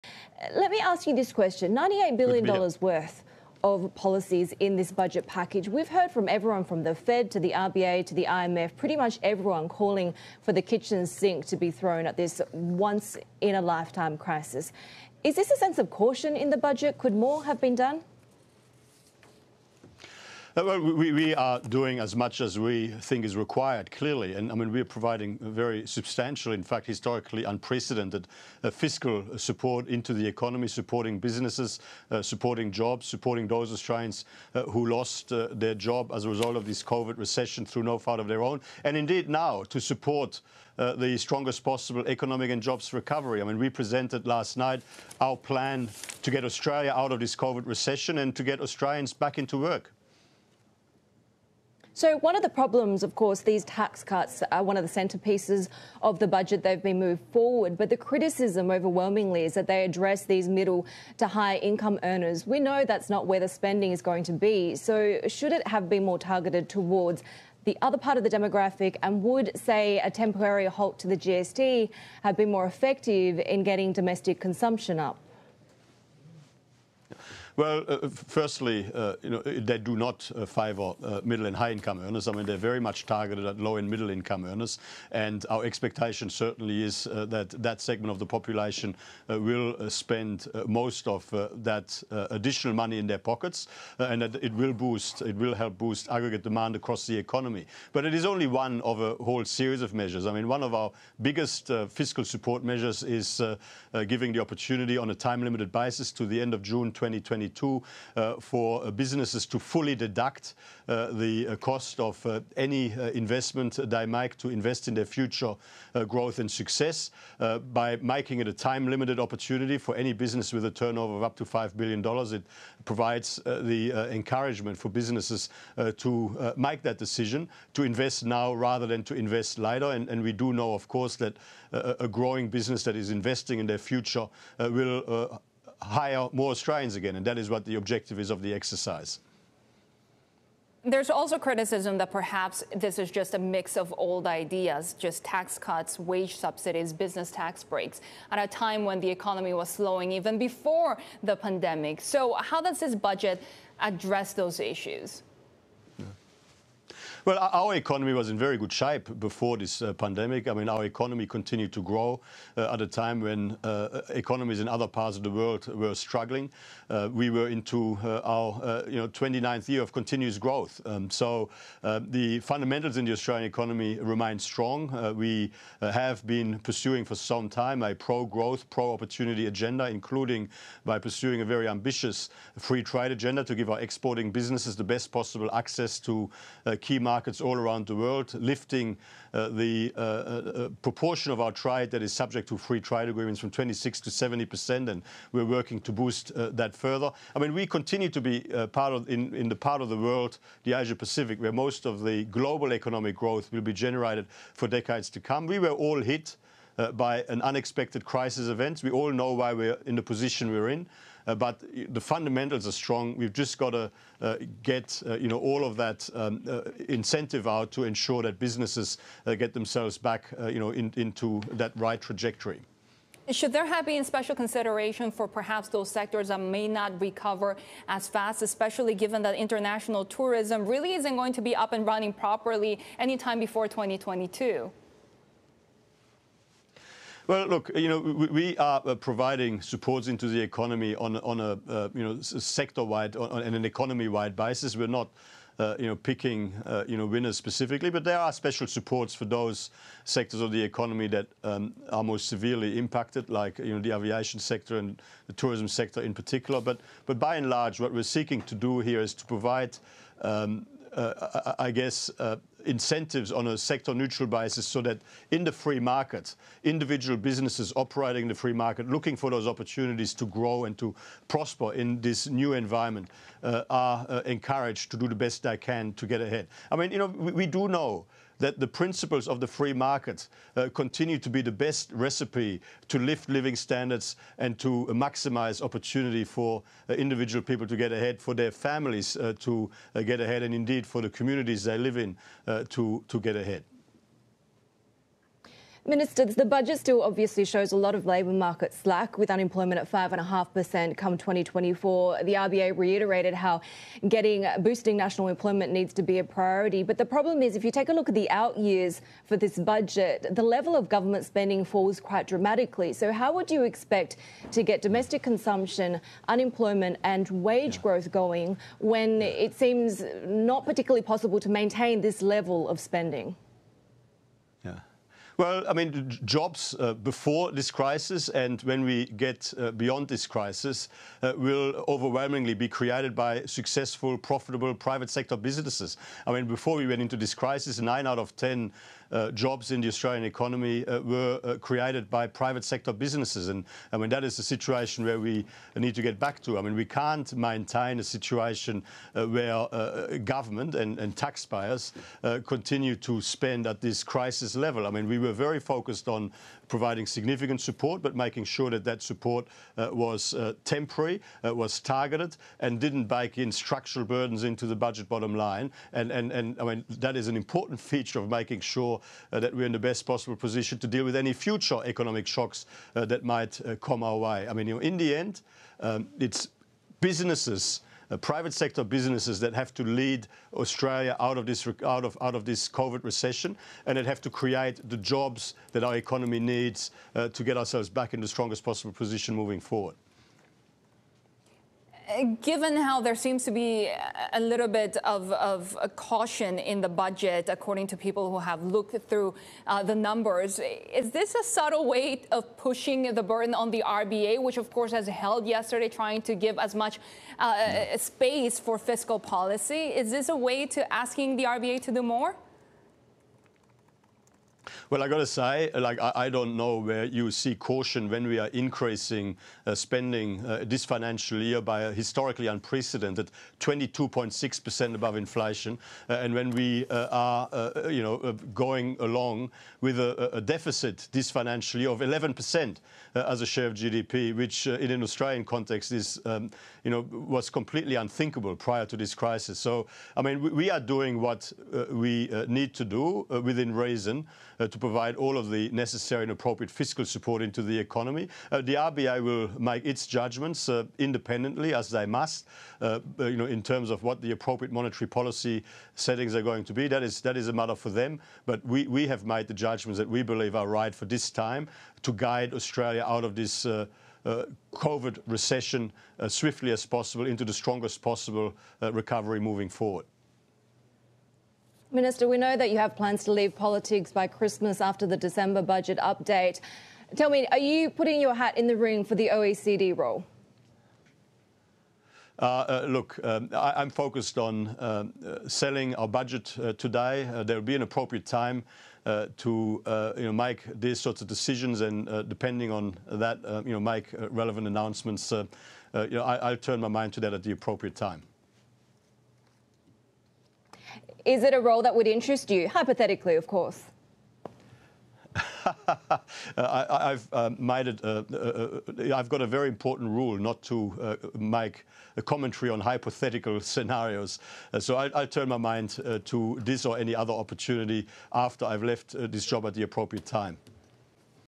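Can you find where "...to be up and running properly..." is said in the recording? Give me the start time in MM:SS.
03:51.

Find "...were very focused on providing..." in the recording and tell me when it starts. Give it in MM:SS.
05:55.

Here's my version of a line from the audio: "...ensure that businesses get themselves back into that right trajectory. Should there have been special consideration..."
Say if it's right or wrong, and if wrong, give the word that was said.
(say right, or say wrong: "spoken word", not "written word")
right.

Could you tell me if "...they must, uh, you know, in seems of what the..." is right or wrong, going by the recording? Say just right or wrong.
wrong.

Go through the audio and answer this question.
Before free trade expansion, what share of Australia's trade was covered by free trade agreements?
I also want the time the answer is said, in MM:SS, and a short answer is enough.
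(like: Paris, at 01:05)
26%, at 03:13.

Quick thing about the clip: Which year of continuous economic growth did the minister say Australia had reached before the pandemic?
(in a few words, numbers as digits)
29th.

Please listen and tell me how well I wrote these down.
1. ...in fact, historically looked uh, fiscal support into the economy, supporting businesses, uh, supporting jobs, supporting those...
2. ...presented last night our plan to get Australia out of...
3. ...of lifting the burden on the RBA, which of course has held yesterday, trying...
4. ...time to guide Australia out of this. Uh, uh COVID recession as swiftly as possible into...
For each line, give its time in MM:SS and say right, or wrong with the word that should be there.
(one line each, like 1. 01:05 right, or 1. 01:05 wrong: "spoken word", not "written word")
1. 00:26 wrong: "unprecedented", not "looked"
2. 00:43 right
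3. 06:42 wrong: "pushing", not "lifting"
4. 07:41 right.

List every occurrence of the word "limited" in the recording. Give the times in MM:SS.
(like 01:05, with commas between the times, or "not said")
01:45, 01:58.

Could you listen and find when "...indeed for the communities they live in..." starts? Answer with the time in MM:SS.
04:50.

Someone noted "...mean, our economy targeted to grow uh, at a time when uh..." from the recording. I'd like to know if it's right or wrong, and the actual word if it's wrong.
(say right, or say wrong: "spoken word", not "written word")
wrong: "continued", not "targeted".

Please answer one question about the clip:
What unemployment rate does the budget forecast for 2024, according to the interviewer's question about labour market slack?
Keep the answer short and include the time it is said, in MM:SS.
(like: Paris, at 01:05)
5.5%, at 04:59.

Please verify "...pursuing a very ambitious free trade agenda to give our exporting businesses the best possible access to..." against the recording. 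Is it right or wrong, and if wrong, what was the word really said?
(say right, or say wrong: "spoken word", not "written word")
right.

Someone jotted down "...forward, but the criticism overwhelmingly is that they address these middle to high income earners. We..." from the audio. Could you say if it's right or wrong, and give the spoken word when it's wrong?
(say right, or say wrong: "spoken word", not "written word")
right.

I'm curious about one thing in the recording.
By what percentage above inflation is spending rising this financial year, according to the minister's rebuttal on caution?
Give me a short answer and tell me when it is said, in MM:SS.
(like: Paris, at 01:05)
22.6%, at 07:03.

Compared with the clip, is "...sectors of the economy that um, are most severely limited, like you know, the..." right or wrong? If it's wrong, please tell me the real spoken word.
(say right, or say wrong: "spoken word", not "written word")
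wrong: "impacted", not "limited".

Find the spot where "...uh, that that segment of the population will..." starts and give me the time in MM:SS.
01:27.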